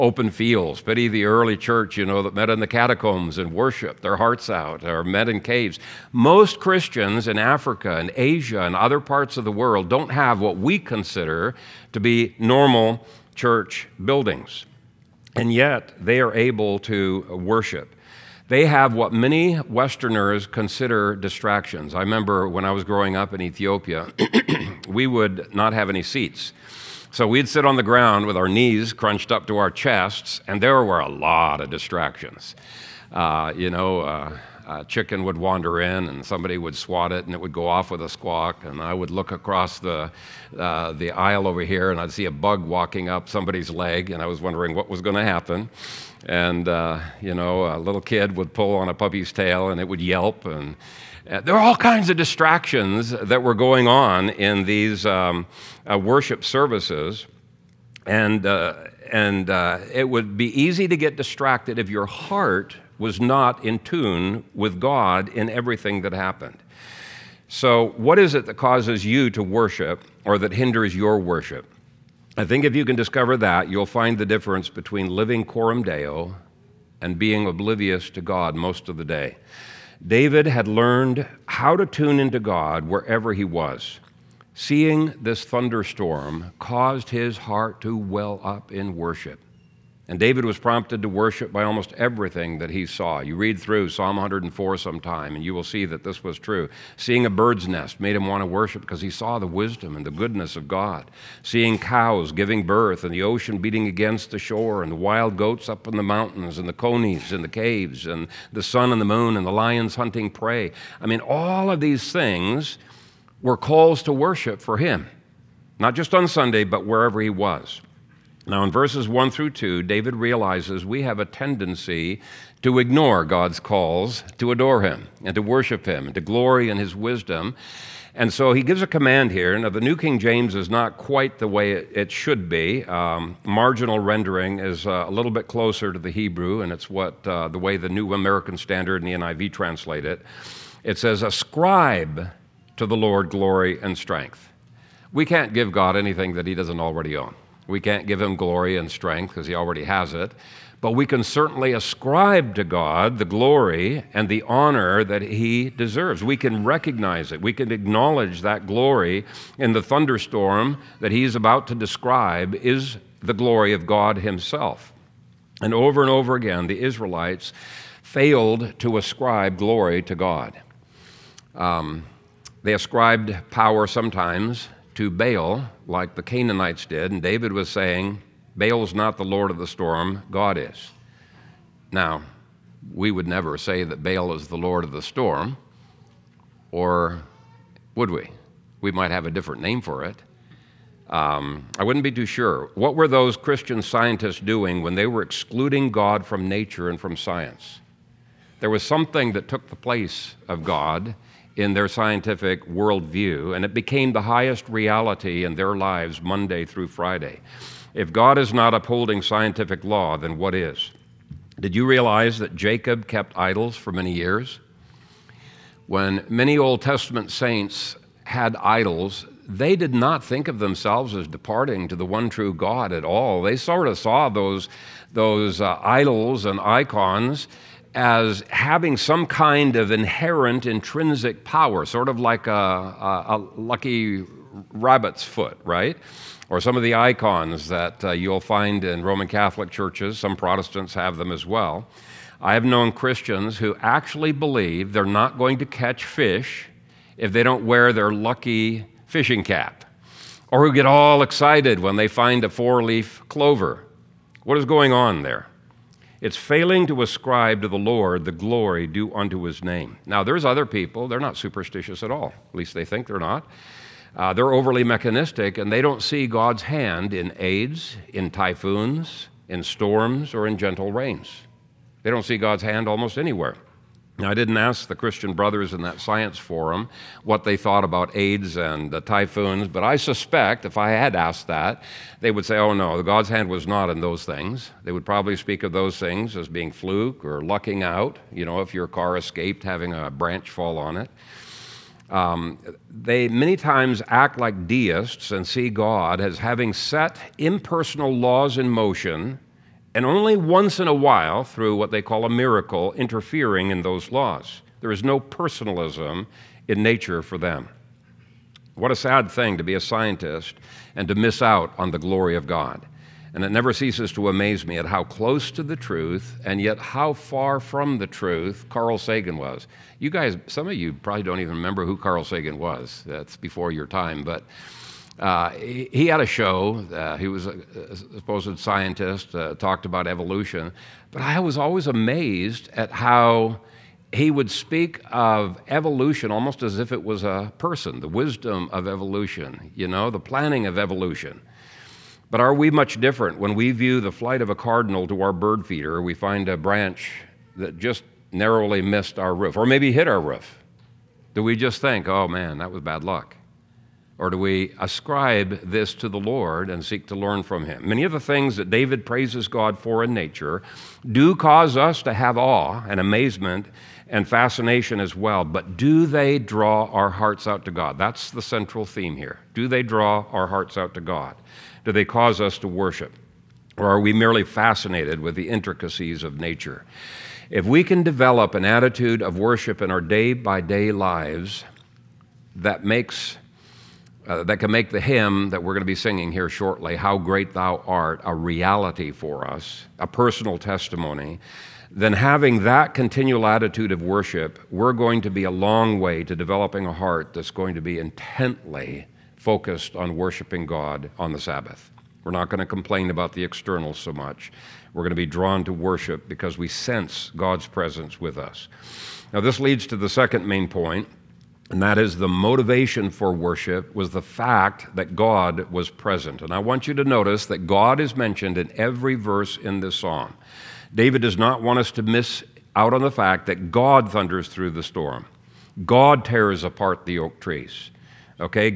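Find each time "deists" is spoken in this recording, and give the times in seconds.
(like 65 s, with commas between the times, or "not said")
294 s.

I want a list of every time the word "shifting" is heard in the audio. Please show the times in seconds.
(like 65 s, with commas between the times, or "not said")
not said.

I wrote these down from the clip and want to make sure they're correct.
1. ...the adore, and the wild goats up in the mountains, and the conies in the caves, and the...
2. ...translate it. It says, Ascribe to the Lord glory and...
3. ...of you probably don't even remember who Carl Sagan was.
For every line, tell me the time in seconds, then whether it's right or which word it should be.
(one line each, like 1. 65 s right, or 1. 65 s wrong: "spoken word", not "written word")
1. 104 s wrong: "shore", not "adore"
2. 139 s right
3. 320 s right.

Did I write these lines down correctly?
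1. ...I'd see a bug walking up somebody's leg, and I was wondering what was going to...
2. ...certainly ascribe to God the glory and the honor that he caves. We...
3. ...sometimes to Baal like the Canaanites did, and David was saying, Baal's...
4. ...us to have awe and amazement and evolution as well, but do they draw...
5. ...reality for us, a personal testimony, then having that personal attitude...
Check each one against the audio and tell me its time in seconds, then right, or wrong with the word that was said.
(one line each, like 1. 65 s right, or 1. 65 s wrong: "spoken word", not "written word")
1. 41 s right
2. 151 s wrong: "deserves", not "caves"
3. 173 s right
4. 361 s wrong: "fascination", not "evolution"
5. 388 s wrong: "continual", not "personal".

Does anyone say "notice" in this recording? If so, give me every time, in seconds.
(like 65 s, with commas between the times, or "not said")
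417 s.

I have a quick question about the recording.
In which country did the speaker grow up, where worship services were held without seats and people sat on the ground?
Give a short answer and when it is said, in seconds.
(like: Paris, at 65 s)
Ethiopia, at 23 s.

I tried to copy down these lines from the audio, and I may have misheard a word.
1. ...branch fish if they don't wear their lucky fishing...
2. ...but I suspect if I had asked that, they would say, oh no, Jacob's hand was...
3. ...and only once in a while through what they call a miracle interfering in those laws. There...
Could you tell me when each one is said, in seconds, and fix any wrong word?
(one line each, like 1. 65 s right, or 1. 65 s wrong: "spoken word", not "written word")
1. 245 s wrong: "catch", not "branch"
2. 279 s wrong: "God", not "Jacob"
3. 299 s right.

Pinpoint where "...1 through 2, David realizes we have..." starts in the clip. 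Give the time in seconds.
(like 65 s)
119 s.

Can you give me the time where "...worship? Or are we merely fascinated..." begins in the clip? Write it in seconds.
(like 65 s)
372 s.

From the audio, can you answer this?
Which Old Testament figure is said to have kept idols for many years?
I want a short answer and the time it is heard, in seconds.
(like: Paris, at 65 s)
Jacob, at 212 s.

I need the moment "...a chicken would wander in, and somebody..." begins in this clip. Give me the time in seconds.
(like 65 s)
34 s.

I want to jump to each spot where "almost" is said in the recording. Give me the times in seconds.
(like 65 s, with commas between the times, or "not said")
91 s, 272 s, 336 s.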